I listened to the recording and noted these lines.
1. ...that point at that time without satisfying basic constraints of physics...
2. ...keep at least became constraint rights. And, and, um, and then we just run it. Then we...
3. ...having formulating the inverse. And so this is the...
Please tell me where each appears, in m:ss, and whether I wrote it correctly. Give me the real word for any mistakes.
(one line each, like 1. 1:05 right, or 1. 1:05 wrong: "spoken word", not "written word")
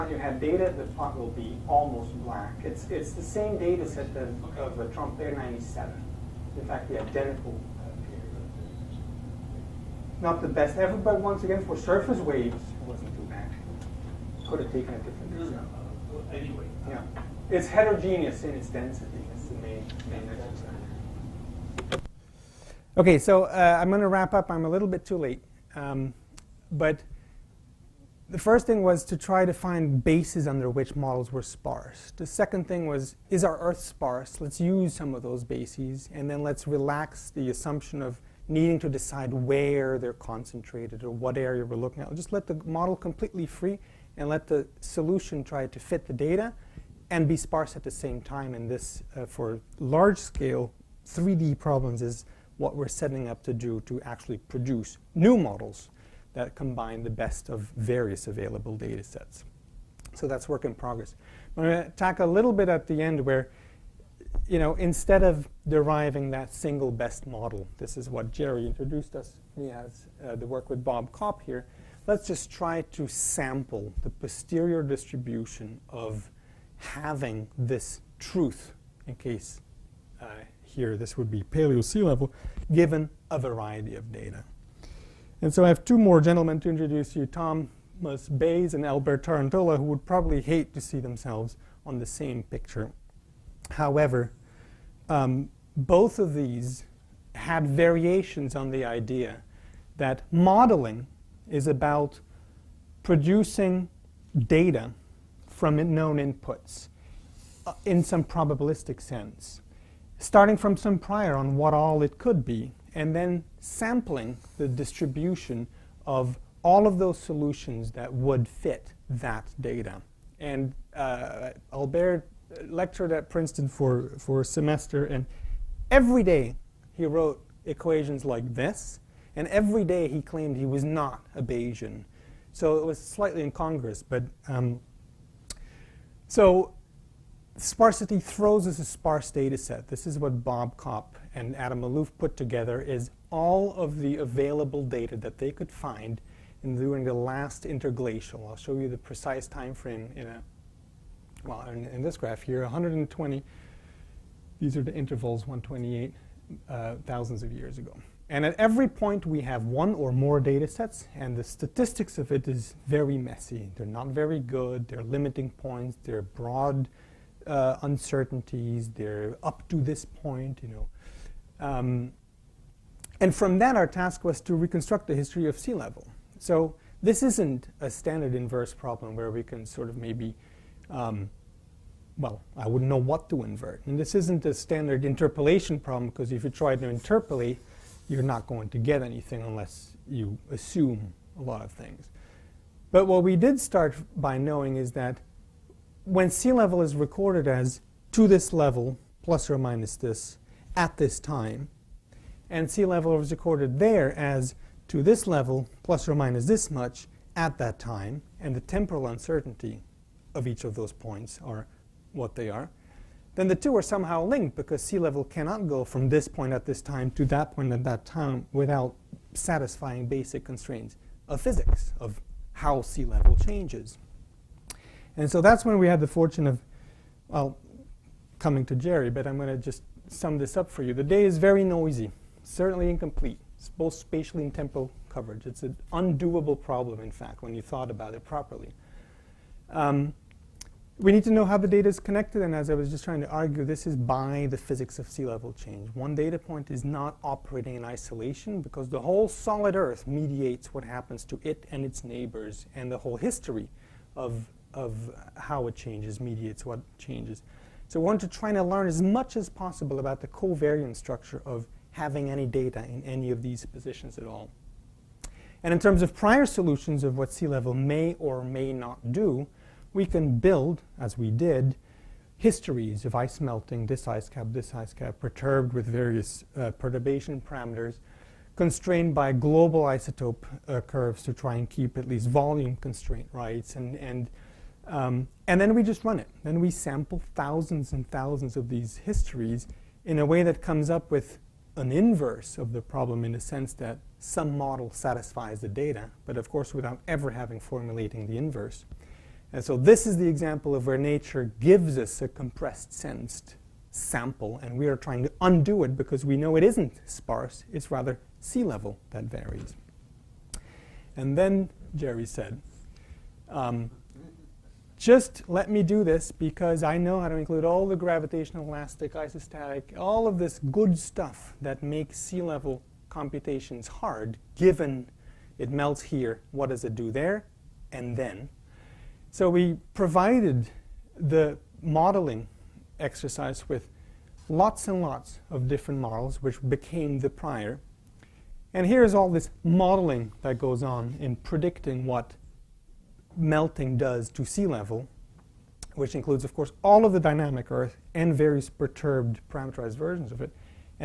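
1. 3:37 right
2. 4:41 wrong: "volume", not "became"
3. 4:57 right.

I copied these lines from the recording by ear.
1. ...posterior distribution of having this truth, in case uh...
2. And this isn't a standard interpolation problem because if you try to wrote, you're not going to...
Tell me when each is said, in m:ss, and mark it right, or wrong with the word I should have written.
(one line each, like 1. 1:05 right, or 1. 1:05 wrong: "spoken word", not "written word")
1. 1:14 right
2. 3:03 wrong: "interpolate", not "wrote".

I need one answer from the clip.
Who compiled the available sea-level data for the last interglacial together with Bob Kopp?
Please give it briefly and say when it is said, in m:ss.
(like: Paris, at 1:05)
Adam Maloof, at 2:21.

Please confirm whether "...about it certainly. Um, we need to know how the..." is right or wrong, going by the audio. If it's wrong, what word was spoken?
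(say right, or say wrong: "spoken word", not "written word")
wrong: "properly", not "certainly".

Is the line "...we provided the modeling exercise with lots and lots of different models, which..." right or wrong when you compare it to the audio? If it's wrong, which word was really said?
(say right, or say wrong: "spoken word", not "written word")
right.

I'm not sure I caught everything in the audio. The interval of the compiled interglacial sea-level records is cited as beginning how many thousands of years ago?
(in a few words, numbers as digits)
128.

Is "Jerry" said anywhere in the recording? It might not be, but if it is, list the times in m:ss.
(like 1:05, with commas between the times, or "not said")
1:08, 3:48, 5:11.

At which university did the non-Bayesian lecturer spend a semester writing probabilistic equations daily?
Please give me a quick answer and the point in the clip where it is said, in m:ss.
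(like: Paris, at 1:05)
Princeton, at 2:03.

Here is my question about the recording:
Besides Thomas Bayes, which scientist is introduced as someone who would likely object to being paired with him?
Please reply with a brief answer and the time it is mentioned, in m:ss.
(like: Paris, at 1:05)
Albert Tarantola, at 1:28.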